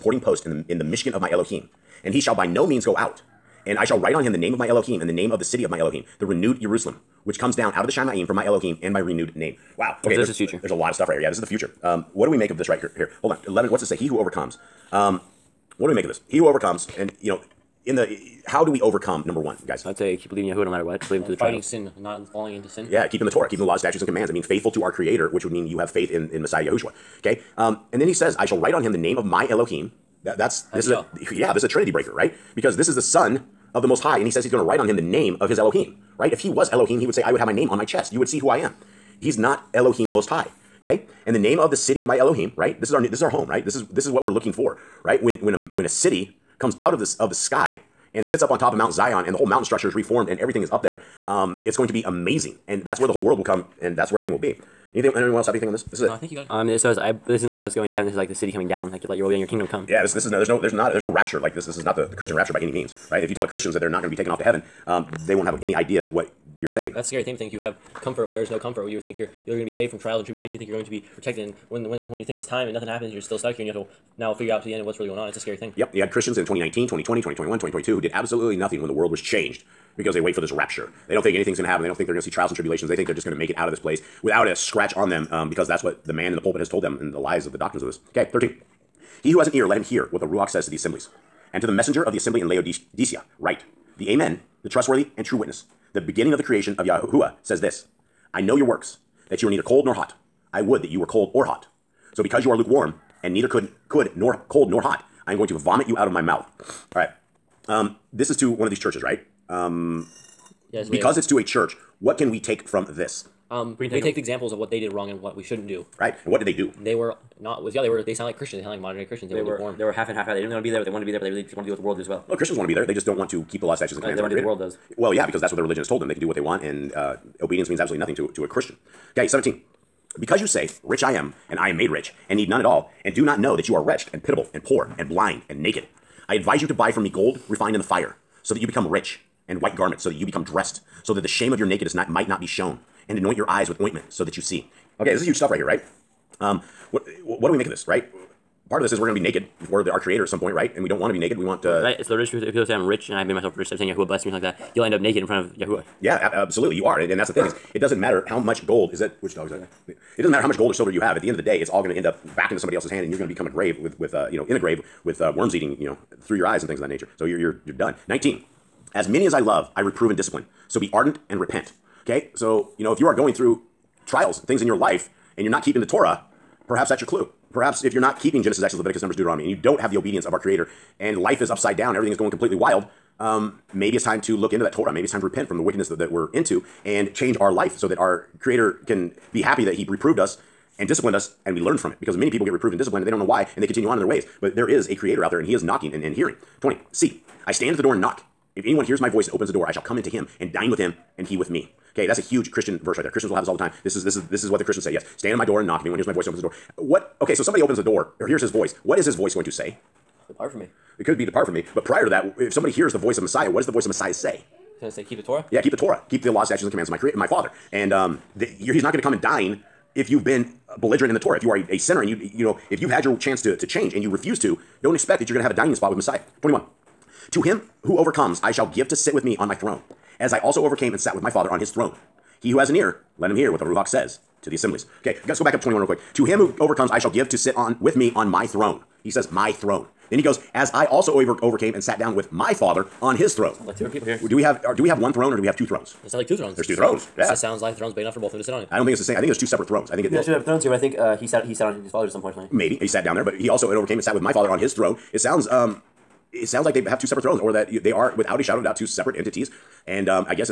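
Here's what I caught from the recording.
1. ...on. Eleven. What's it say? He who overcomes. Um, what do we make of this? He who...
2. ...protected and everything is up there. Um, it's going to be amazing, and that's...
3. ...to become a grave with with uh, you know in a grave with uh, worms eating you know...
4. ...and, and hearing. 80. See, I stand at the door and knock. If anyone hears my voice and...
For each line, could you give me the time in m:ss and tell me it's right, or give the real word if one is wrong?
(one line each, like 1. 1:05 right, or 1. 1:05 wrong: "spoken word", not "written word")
1. 0:13 right
2. 0:49 wrong: "reformed", not "protected"
3. 2:43 right
4. 3:15 wrong: "20", not "80".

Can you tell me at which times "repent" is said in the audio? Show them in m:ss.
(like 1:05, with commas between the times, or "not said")
2:51, 3:05.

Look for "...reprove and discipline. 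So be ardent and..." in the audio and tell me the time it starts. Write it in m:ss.
2:49.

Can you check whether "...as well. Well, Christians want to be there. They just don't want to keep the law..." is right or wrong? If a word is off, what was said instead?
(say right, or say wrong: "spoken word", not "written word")
right.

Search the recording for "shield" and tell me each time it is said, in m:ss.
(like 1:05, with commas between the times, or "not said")
not said.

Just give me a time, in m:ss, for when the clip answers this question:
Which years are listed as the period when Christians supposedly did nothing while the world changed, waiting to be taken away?
1:16.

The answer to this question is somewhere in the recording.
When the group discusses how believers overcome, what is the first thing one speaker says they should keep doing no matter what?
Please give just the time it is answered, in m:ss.
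0:20.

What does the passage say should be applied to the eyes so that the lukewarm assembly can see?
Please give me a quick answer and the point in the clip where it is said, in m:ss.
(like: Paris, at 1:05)
Ointment, at 2:23.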